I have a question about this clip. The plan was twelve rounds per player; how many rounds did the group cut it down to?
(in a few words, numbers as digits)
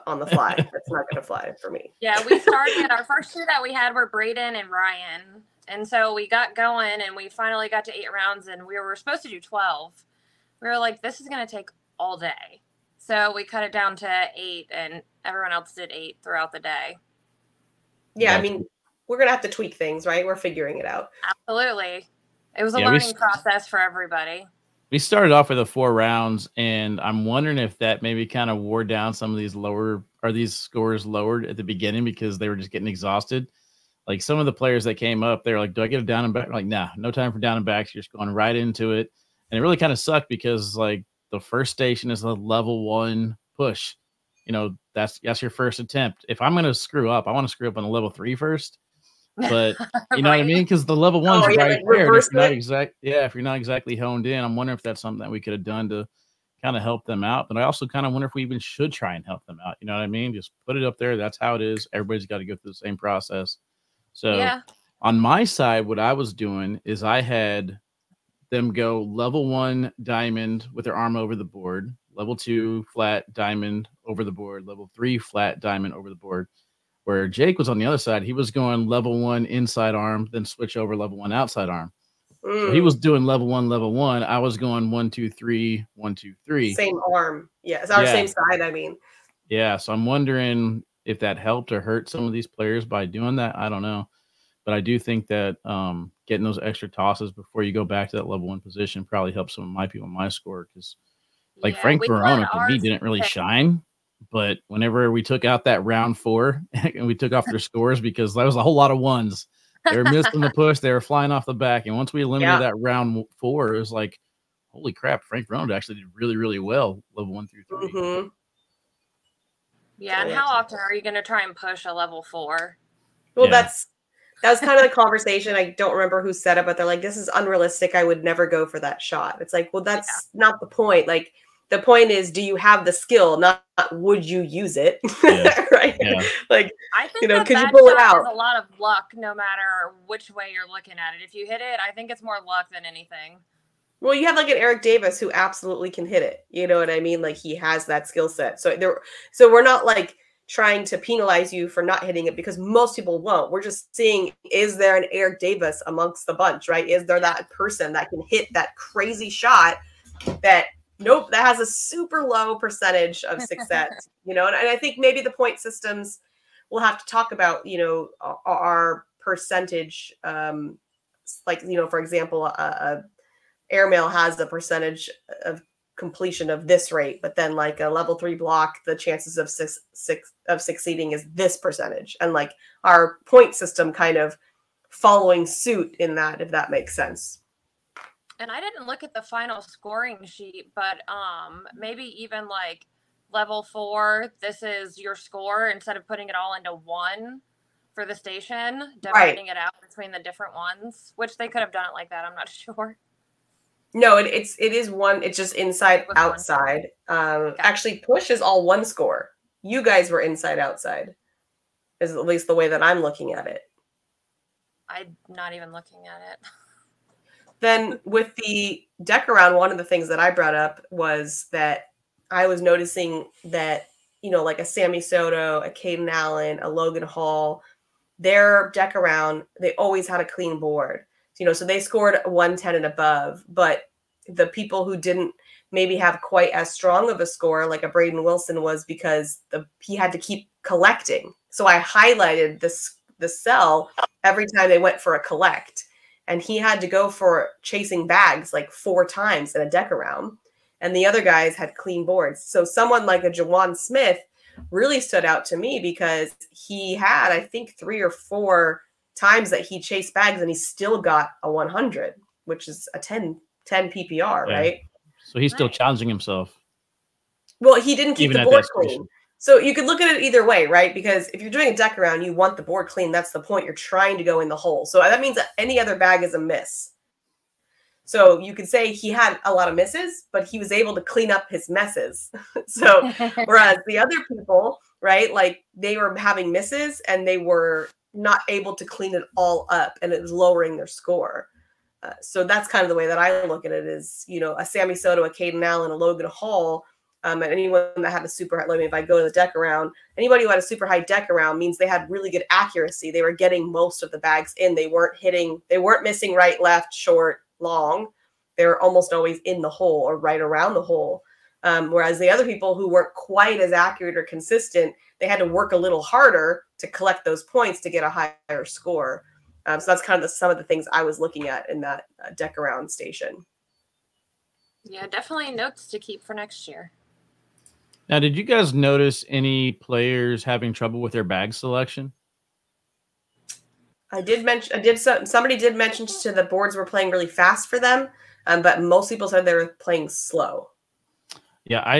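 8.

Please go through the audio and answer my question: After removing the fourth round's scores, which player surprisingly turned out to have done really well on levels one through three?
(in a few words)
Frank Brown.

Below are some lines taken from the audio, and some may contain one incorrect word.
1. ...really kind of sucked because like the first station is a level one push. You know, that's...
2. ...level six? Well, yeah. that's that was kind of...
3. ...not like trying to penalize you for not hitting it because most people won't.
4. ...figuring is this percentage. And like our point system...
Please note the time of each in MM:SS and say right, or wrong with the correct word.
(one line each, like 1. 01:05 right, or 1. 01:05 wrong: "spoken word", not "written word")
1. 00:39 right
2. 02:01 wrong: "four", not "six"
3. 02:29 right
4. 03:00 wrong: "succeeding", not "figuring".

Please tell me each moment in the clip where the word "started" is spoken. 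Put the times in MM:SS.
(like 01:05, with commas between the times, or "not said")
00:02, 00:24.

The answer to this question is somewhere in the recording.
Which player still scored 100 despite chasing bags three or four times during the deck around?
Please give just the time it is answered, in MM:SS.
04:13.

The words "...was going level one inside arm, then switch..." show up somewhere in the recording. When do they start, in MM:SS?
01:18.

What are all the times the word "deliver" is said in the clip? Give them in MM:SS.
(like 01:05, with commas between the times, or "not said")
not said.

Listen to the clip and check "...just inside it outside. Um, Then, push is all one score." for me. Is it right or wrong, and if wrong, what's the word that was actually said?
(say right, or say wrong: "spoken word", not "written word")
wrong: "Actually", not "Then".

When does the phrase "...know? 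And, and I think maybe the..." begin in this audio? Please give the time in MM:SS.
02:44.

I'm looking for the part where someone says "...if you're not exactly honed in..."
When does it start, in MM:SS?
00:53.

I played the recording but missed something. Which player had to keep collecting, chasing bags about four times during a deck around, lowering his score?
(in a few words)
Braden Wilson.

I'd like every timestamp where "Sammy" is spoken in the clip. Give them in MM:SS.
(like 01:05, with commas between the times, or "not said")
03:44, 04:54.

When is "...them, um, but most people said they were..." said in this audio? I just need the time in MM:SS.
05:37.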